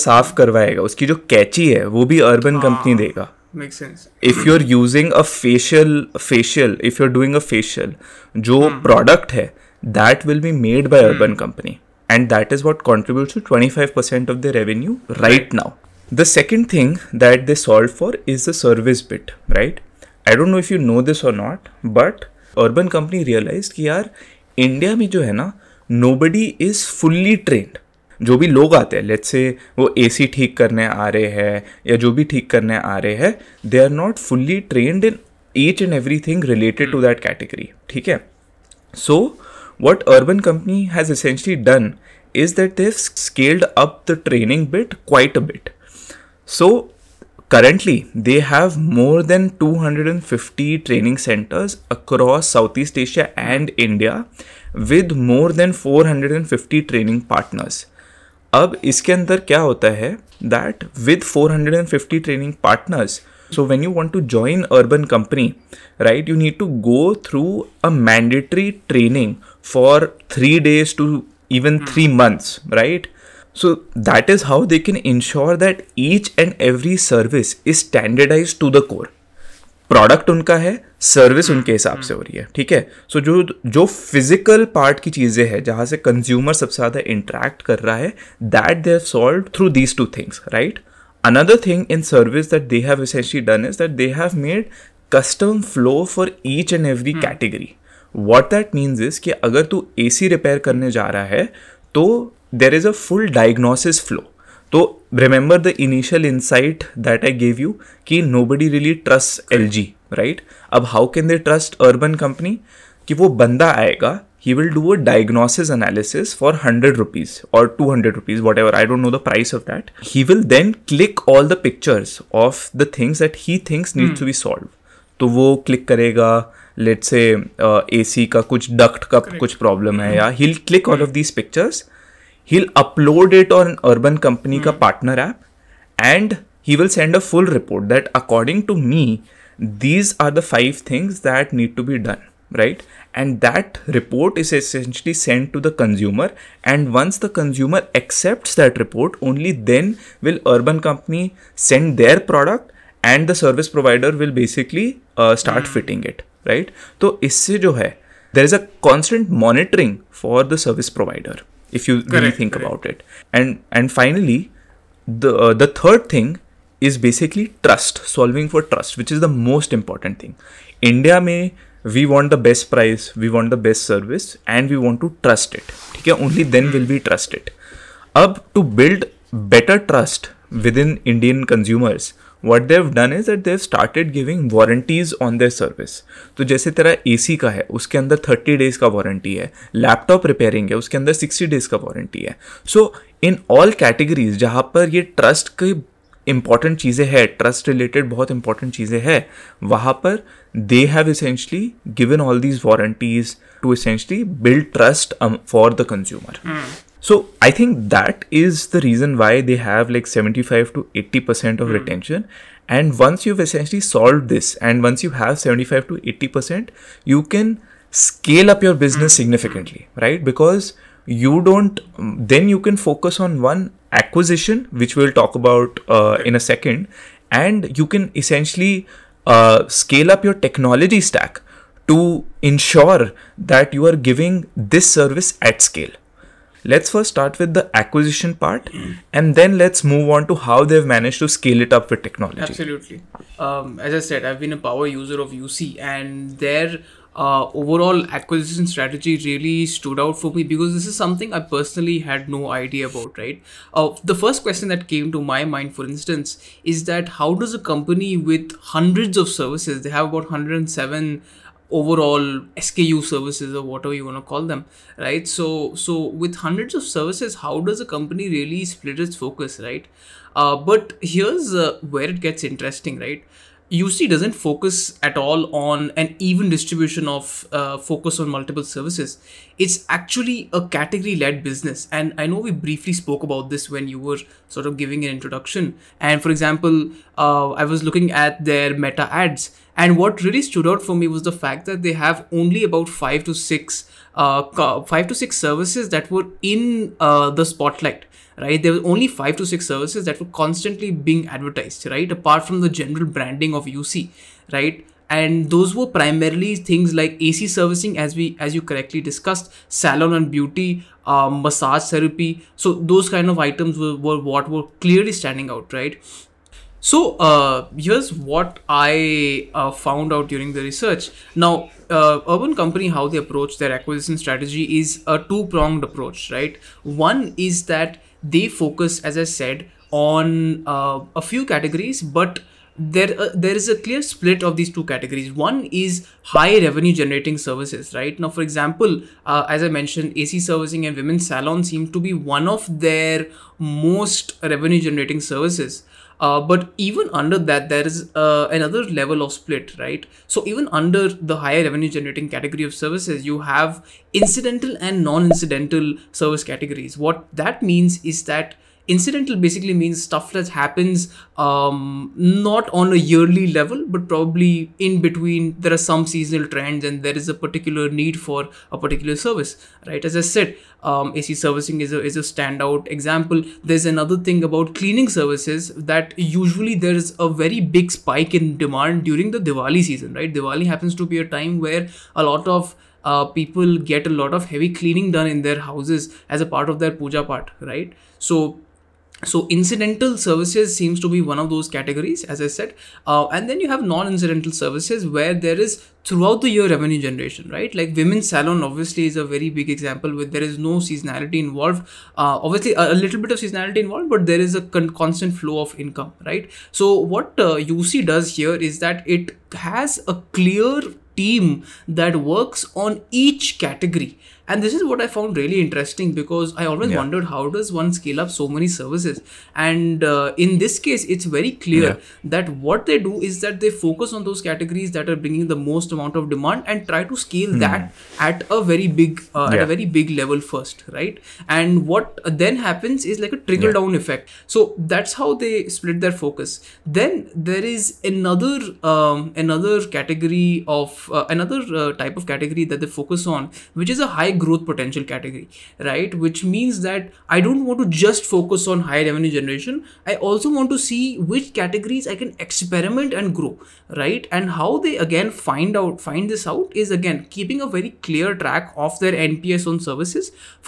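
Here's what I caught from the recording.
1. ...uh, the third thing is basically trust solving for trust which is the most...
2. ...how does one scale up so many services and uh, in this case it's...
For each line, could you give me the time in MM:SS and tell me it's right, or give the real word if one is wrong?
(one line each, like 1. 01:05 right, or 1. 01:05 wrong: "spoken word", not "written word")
1. 02:45 right
2. 06:57 right.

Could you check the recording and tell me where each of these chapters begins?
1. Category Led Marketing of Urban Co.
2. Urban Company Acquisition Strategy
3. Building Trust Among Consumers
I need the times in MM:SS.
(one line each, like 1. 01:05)
1. 05:37
2. 03:59
3. 02:45.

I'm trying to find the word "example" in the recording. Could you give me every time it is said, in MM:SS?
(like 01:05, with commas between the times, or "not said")
04:46, 05:38, 06:12, 06:39.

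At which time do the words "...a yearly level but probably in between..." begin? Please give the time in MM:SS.
06:02.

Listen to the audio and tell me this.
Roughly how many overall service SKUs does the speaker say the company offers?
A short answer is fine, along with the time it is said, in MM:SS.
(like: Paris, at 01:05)
107, at 04:20.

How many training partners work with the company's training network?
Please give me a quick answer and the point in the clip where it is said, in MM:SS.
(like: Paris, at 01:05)
More than 450, at 00:55.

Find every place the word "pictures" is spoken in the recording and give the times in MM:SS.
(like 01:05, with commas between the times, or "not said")
02:01.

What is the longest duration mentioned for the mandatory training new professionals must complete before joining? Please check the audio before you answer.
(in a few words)
3 months.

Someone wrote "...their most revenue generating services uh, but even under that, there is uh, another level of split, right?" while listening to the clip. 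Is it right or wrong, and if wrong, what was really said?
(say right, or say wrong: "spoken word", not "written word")
right.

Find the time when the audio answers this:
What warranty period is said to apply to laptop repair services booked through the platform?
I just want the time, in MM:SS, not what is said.
03:11.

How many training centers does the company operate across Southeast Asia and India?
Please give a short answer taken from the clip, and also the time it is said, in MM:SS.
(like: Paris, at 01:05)
More than 250, at 00:48.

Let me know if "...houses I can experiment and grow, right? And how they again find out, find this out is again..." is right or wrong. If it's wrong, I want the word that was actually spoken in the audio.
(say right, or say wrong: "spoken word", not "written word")
wrong: "categories", not "houses".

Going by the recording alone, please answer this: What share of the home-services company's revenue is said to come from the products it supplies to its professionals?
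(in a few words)
25%.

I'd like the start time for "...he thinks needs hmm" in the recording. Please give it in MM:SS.
02:03.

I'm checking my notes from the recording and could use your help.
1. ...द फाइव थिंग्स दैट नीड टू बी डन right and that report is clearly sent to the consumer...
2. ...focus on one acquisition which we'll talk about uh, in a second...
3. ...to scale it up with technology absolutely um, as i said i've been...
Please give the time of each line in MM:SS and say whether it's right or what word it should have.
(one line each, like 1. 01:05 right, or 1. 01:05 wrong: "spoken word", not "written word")
1. 02:20 wrong: "essentially", not "clearly"
2. 03:42 right
3. 04:01 right.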